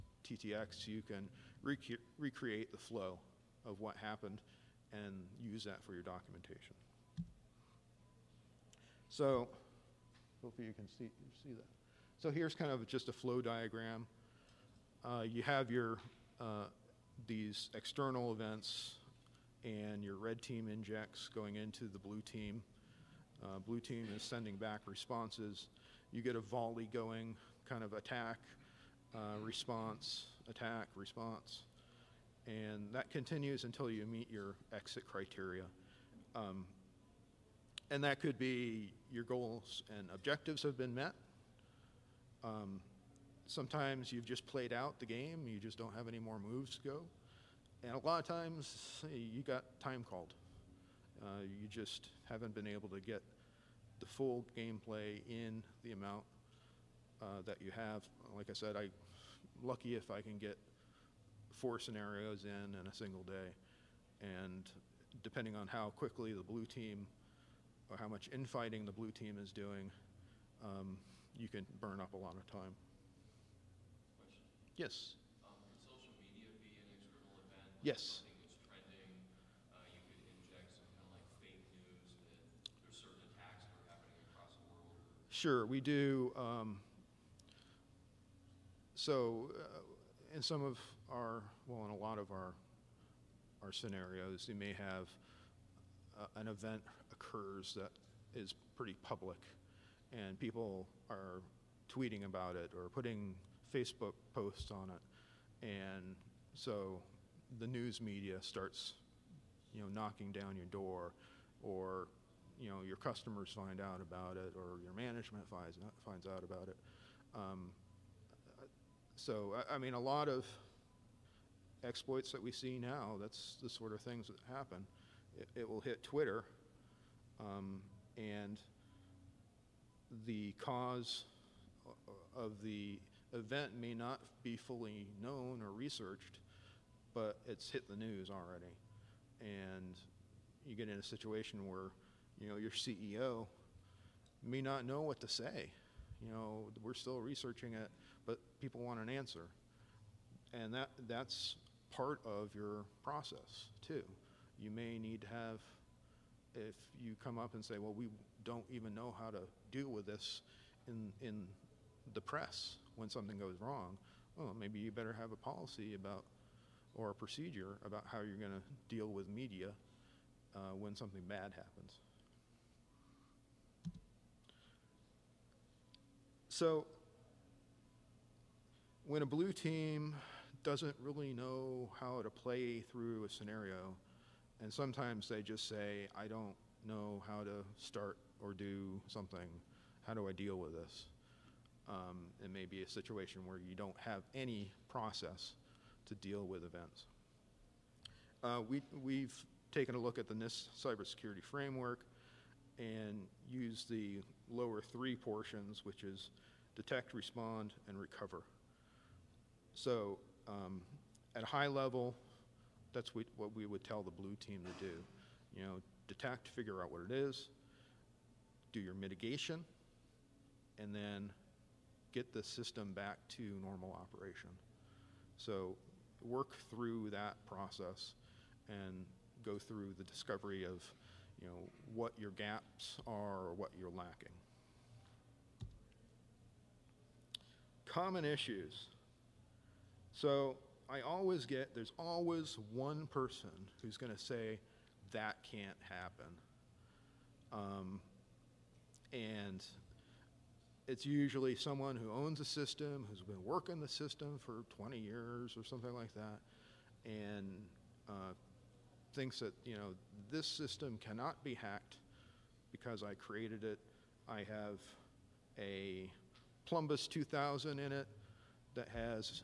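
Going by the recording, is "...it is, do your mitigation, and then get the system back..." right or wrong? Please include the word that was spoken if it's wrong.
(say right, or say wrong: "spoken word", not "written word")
right.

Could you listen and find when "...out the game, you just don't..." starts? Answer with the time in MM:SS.
00:44.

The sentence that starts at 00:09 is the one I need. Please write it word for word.
So Hopefully you can see, see that.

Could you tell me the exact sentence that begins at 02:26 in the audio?
You know, we're still researching it, but people want an answer.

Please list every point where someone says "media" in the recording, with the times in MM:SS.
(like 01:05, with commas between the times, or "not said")
01:16, 01:48, 02:49.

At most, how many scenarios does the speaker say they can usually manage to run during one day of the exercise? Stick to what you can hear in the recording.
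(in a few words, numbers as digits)
4.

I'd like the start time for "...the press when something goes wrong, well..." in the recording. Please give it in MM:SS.
02:42.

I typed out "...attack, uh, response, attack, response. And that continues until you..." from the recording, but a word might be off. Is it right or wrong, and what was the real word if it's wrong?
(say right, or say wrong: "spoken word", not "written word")
right.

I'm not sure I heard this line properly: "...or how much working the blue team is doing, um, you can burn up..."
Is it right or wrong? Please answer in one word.
wrong.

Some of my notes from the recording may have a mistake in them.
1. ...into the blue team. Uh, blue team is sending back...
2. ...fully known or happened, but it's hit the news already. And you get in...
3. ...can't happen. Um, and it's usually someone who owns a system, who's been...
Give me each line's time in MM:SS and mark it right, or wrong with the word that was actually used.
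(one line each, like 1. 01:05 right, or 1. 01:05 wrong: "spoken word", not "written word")
1. 00:21 right
2. 02:14 wrong: "researched", not "happened"
3. 04:05 right.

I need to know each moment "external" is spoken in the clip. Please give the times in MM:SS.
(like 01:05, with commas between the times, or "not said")
00:17, 01:17.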